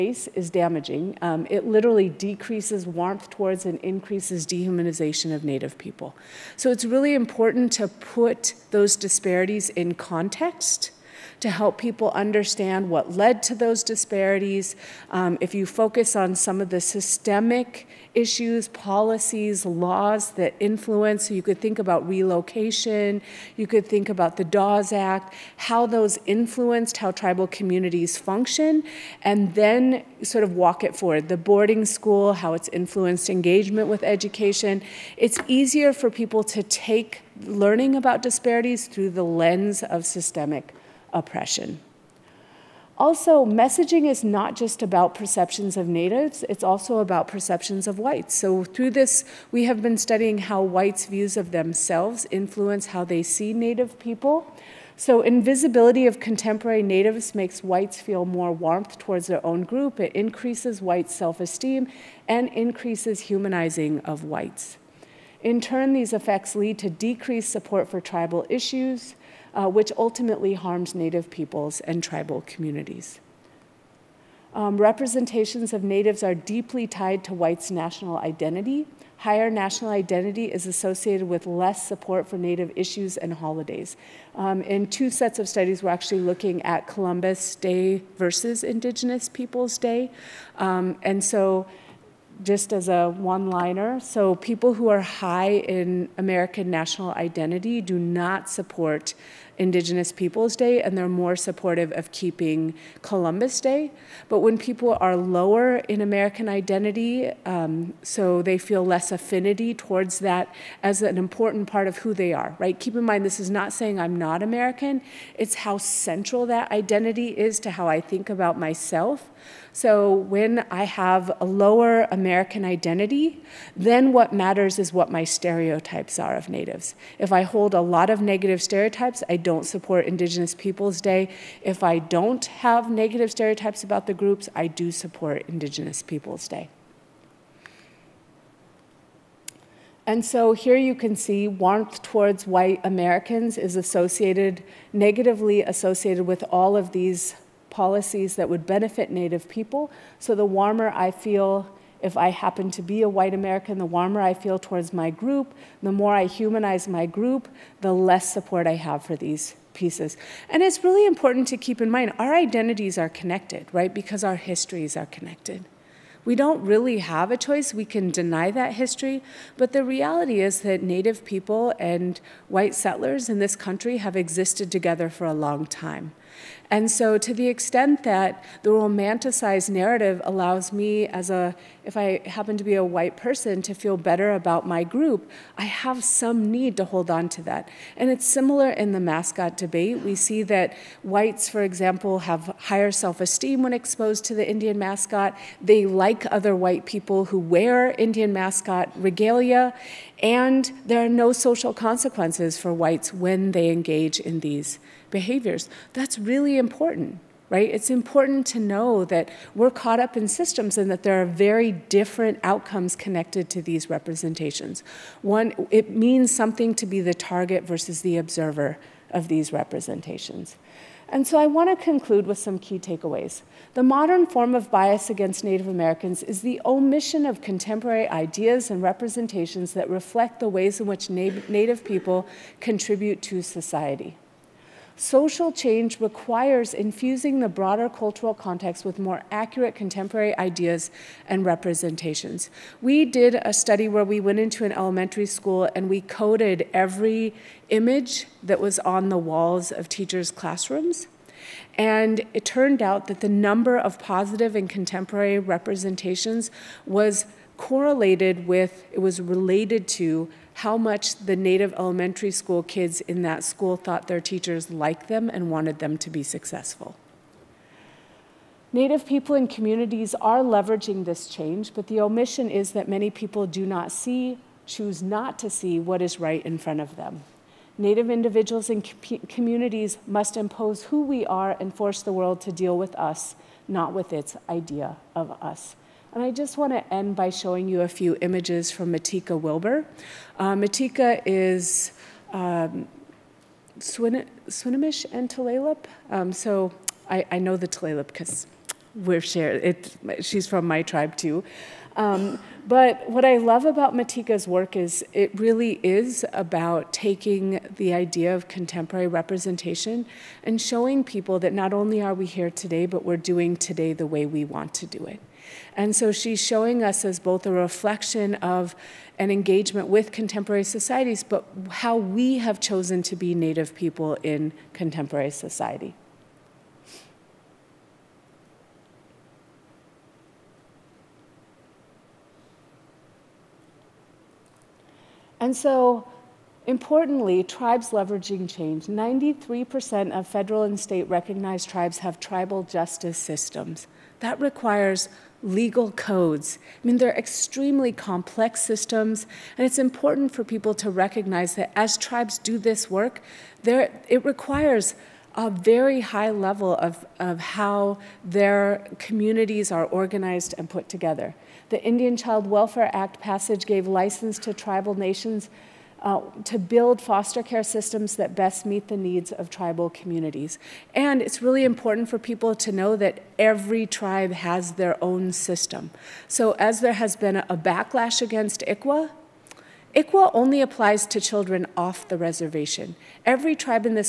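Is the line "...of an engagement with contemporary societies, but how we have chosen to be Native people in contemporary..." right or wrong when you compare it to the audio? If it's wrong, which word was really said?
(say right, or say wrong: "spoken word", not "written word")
right.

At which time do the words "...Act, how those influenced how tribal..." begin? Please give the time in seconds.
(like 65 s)
24 s.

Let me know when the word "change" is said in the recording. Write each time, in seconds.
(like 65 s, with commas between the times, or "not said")
235 s, 271 s, 338 s.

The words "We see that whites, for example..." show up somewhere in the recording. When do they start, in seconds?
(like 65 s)
190 s.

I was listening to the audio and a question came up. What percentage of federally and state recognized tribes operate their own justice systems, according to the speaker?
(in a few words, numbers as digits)
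93%.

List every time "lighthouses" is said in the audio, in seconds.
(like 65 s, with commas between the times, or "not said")
not said.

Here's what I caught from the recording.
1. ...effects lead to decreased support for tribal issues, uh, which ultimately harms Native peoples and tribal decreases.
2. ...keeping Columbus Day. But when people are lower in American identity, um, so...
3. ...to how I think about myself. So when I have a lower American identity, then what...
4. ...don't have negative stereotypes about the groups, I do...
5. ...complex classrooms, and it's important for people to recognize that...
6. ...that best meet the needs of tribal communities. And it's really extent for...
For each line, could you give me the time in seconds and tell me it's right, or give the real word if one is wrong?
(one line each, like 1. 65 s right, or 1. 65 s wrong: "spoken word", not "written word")
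1. 66 s wrong: "communities", not "decreases"
2. 102 s right
3. 117 s right
4. 131 s right
5. 347 s wrong: "systems", not "classrooms"
6. 368 s wrong: "important", not "extent".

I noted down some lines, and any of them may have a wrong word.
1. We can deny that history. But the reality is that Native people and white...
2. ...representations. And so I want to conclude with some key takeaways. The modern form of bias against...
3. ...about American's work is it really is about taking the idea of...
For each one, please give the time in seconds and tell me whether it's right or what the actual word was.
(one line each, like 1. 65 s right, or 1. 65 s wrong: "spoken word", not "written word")
1. 167 s right
2. 219 s right
3. 303 s wrong: "Matika", not "American".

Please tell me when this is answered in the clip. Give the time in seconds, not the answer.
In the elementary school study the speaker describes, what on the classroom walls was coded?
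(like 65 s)
246 s.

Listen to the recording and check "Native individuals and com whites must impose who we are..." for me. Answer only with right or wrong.
wrong.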